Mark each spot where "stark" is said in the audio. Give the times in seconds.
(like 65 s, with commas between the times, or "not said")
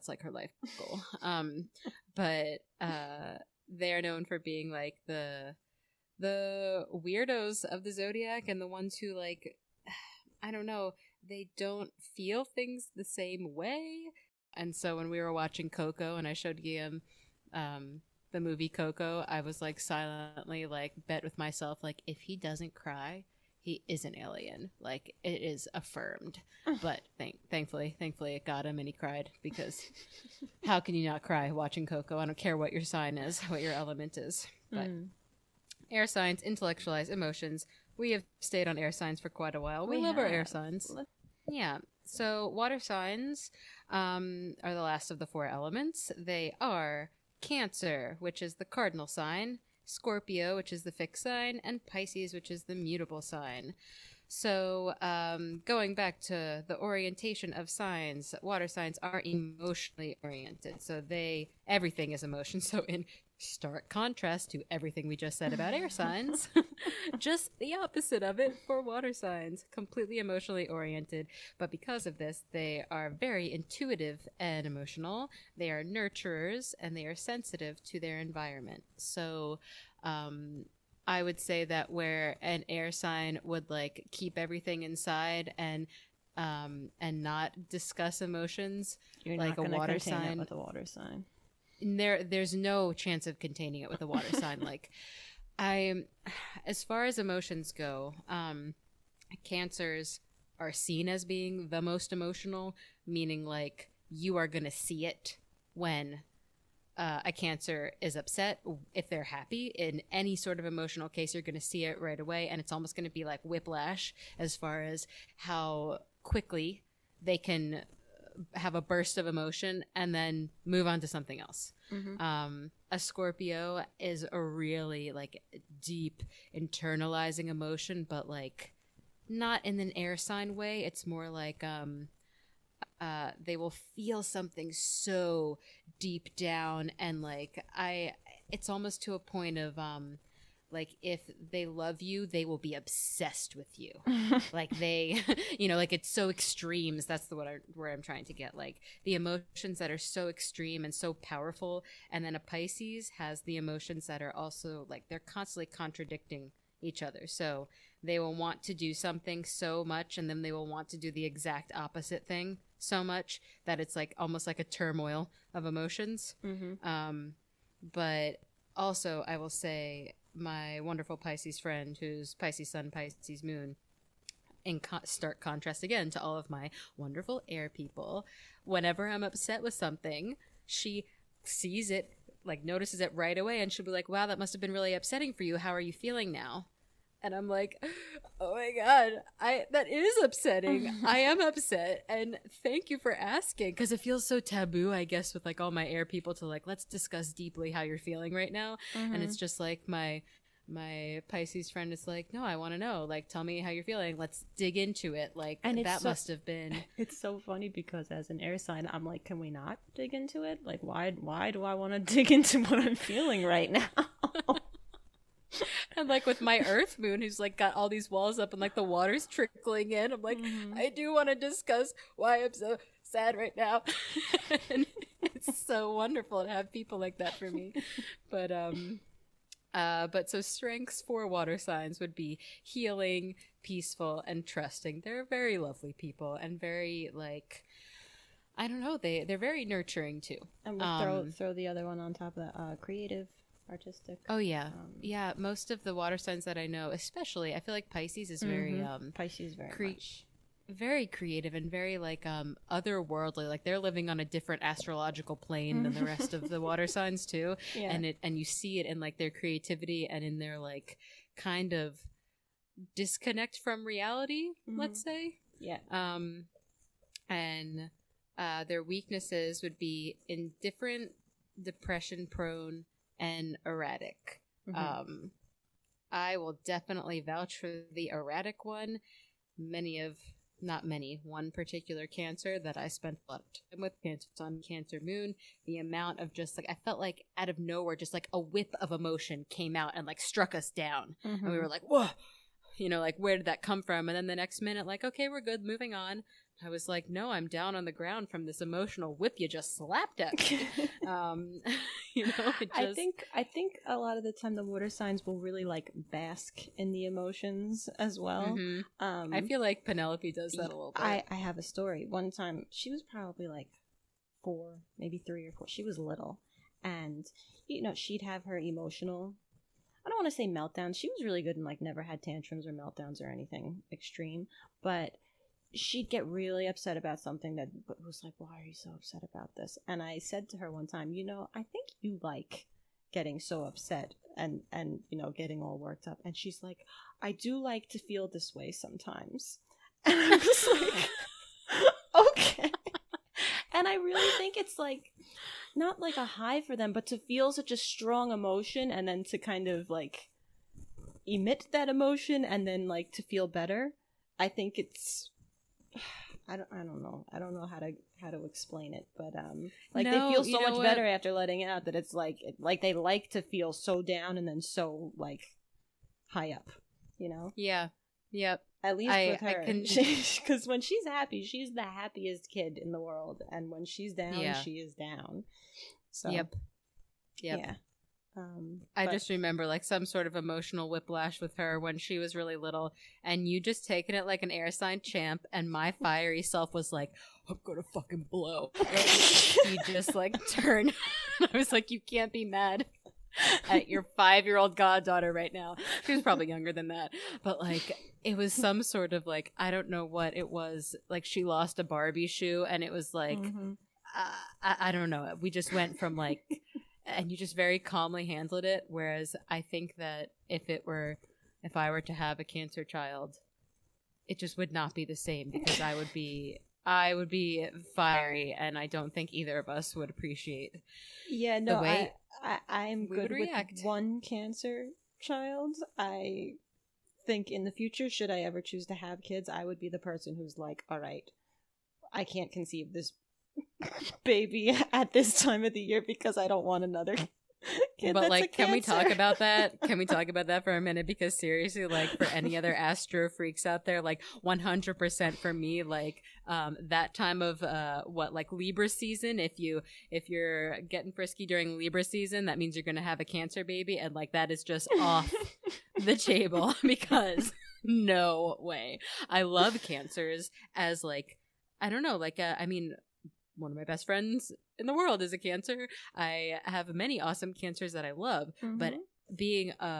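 63 s, 175 s.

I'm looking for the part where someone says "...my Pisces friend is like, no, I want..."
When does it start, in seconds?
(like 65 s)
200 s.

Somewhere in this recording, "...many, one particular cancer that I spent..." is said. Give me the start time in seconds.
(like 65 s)
280 s.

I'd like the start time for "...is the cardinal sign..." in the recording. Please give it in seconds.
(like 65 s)
48 s.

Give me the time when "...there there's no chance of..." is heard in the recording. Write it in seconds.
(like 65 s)
91 s.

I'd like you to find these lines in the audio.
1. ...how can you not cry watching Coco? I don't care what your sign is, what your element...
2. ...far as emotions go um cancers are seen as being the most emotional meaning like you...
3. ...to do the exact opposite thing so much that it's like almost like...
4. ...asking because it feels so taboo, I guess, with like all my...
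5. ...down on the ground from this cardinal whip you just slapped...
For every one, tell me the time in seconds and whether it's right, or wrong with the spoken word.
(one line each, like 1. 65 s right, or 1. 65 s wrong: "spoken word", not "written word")
1. 30 s right
2. 96 s right
3. 160 s right
4. 193 s right
5. 297 s wrong: "emotional", not "cardinal".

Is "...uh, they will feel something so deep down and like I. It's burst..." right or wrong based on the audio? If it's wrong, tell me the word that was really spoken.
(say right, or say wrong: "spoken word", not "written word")
wrong: "almost", not "burst".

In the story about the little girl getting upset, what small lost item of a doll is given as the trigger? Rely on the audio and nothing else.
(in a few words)
Barbie shoe.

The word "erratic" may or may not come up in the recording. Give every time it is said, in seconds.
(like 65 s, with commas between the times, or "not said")
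273 s, 278 s.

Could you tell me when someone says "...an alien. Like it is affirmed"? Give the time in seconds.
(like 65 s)
24 s.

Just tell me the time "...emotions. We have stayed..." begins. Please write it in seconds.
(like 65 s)
37 s.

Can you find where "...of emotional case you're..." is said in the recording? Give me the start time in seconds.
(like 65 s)
110 s.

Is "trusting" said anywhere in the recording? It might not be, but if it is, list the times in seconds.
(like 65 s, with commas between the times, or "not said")
234 s.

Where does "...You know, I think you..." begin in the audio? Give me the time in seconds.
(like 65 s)
331 s.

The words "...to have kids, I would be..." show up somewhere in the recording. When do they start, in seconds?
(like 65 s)
428 s.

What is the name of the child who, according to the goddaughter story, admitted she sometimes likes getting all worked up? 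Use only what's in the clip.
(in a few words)
Penelope.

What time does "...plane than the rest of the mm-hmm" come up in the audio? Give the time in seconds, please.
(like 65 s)
255 s.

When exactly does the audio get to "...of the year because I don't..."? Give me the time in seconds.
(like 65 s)
435 s.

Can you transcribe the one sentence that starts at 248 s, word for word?
very um, Pisces very cre- much.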